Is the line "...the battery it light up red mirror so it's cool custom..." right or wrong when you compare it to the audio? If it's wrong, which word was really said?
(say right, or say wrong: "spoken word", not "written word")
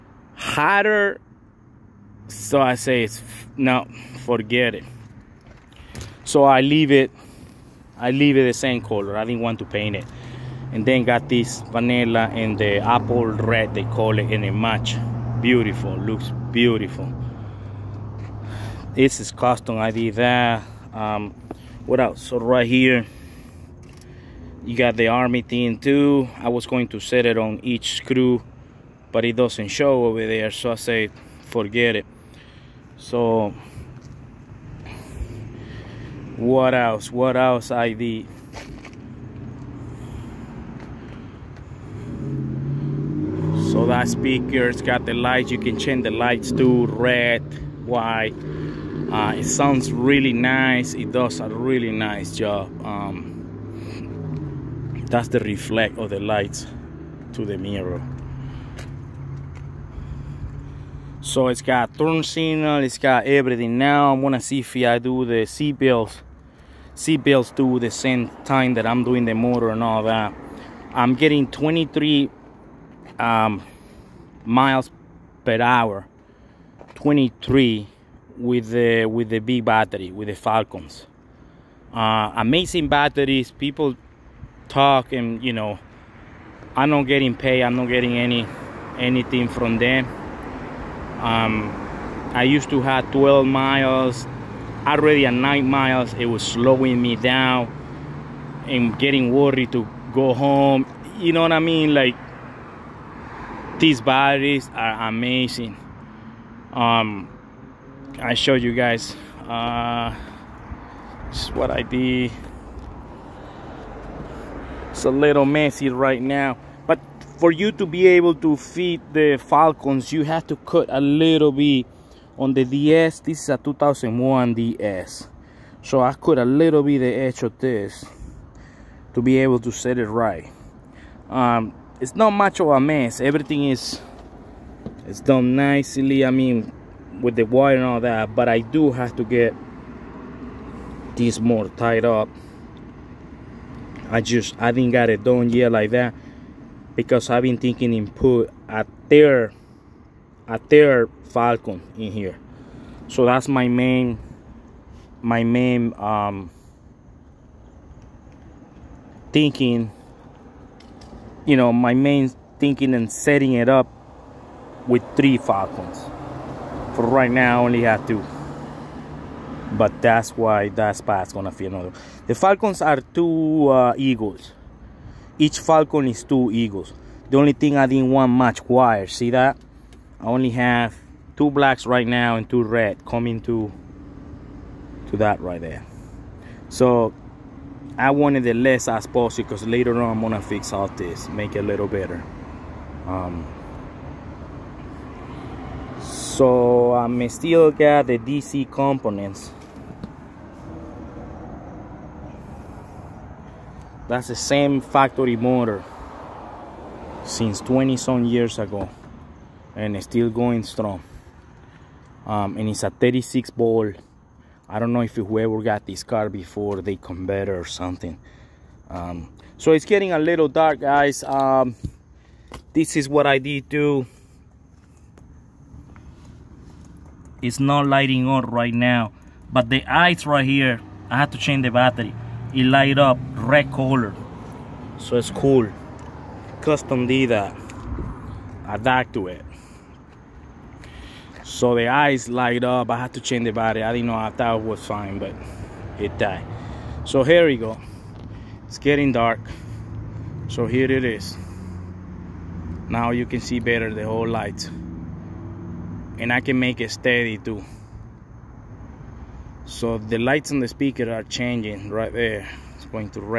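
wrong: "color", not "mirror".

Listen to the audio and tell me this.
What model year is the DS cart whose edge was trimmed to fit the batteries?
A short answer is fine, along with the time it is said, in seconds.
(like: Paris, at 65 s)
2001, at 123 s.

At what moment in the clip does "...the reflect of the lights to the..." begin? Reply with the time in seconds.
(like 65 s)
55 s.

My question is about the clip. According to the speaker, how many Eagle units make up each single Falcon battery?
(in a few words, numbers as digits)
2.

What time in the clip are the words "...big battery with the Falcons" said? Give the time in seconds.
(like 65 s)
79 s.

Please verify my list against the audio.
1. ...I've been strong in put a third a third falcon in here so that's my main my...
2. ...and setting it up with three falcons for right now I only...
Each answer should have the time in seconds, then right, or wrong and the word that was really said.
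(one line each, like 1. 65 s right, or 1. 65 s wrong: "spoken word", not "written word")
1. 147 s wrong: "thinking", not "strong"
2. 162 s right.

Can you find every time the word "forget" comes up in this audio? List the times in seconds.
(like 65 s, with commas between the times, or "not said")
4 s, 31 s.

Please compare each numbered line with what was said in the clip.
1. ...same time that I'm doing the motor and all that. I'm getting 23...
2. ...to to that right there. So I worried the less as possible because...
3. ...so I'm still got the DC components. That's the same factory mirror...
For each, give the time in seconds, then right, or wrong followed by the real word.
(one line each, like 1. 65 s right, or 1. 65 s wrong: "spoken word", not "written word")
1. 67 s right
2. 183 s wrong: "wanted", not "worried"
3. 196 s wrong: "motor", not "mirror".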